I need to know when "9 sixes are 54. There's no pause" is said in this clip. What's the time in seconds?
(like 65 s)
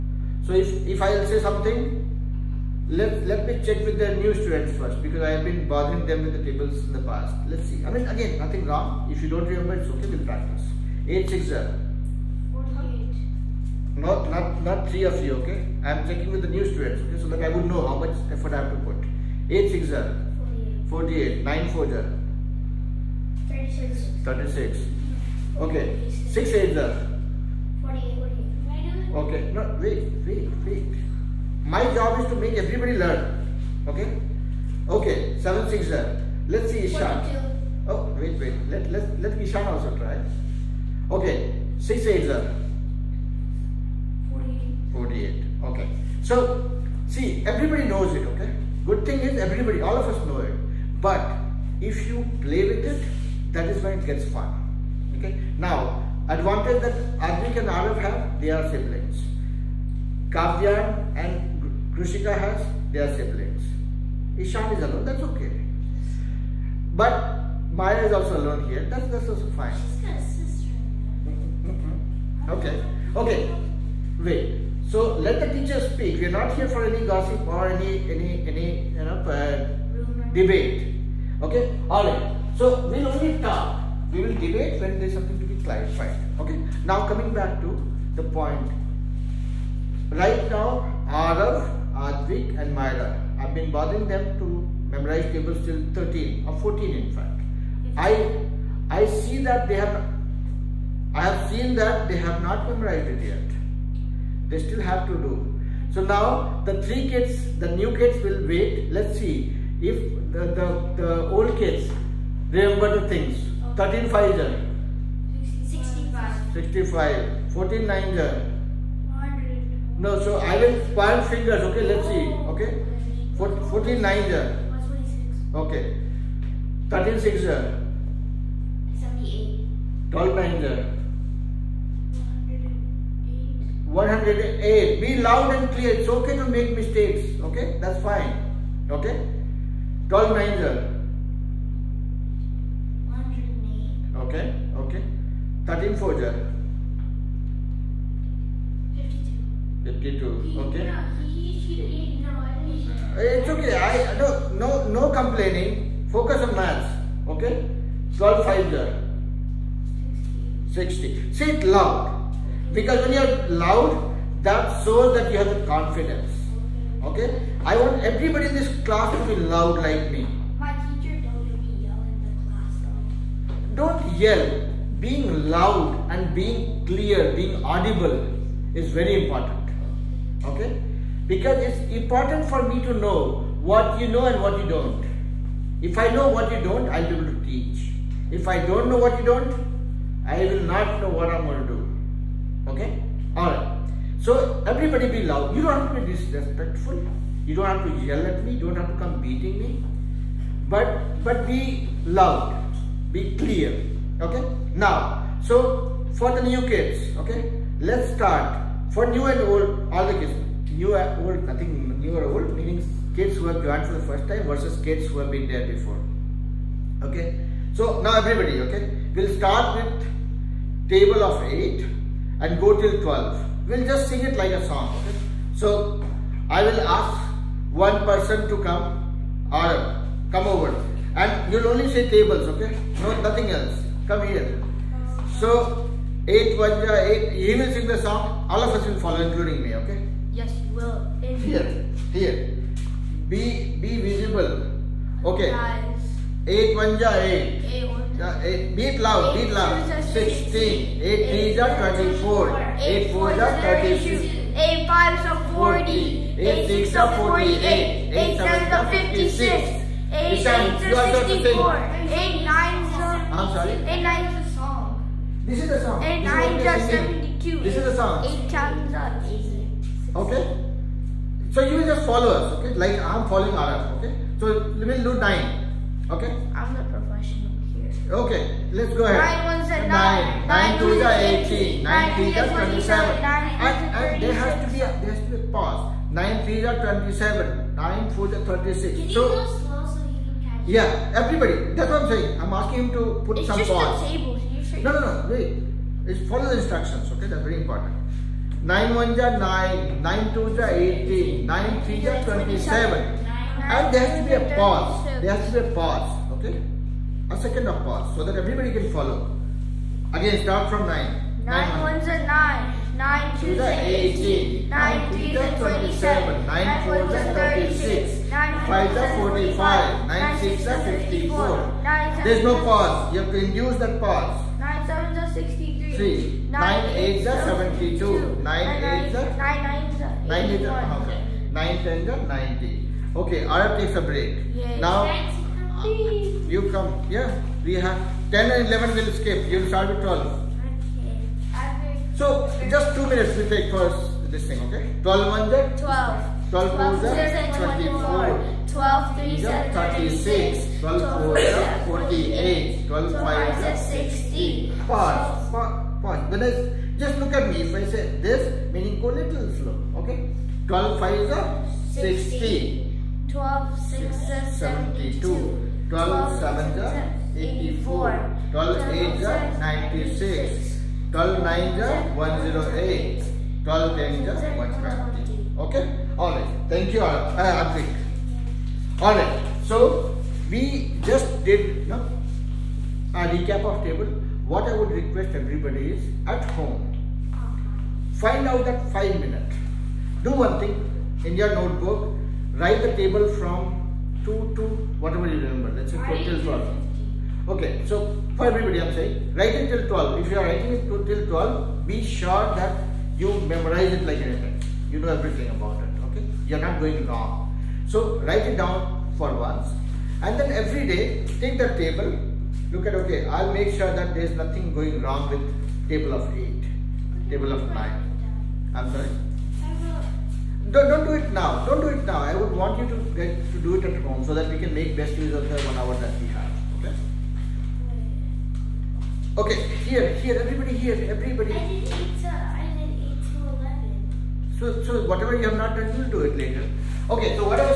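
320 s.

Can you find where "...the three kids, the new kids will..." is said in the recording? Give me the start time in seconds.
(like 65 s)
106 s.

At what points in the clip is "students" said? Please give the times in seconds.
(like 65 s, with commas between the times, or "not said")
4 s, 16 s.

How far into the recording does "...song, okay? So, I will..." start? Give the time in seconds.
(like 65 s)
224 s.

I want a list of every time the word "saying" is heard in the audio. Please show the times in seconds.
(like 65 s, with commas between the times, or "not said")
292 s, 398 s.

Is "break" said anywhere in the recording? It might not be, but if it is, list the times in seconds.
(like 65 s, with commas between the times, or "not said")
334 s.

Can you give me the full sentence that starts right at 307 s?
A second of pause so that everybody can follow.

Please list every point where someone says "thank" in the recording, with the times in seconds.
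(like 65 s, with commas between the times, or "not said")
376 s.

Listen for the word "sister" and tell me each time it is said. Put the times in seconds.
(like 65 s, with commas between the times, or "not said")
70 s.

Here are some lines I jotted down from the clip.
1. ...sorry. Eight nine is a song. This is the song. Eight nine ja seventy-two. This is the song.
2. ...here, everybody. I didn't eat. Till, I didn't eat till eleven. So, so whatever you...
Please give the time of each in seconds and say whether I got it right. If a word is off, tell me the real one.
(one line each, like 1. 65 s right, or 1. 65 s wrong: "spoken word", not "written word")
1. 263 s right
2. 430 s right.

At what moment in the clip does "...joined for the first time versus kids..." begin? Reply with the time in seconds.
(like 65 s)
213 s.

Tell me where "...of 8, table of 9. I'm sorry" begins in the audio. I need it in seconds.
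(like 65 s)
416 s.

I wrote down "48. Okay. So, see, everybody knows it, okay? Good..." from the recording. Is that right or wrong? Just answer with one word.
right.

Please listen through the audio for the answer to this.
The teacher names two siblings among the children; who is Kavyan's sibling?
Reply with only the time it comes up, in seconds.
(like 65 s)
61 s.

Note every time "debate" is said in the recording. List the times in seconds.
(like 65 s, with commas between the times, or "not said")
80 s, 84 s.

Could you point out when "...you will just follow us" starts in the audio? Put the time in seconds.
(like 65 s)
271 s.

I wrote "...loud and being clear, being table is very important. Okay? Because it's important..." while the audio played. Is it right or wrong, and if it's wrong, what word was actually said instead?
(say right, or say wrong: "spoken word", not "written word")
wrong: "audible", not "table".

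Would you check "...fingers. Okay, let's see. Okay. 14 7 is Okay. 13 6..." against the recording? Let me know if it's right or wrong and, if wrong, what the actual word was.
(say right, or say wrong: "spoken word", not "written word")
wrong: "9", not "7".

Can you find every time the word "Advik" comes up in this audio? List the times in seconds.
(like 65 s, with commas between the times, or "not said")
57 s, 91 s.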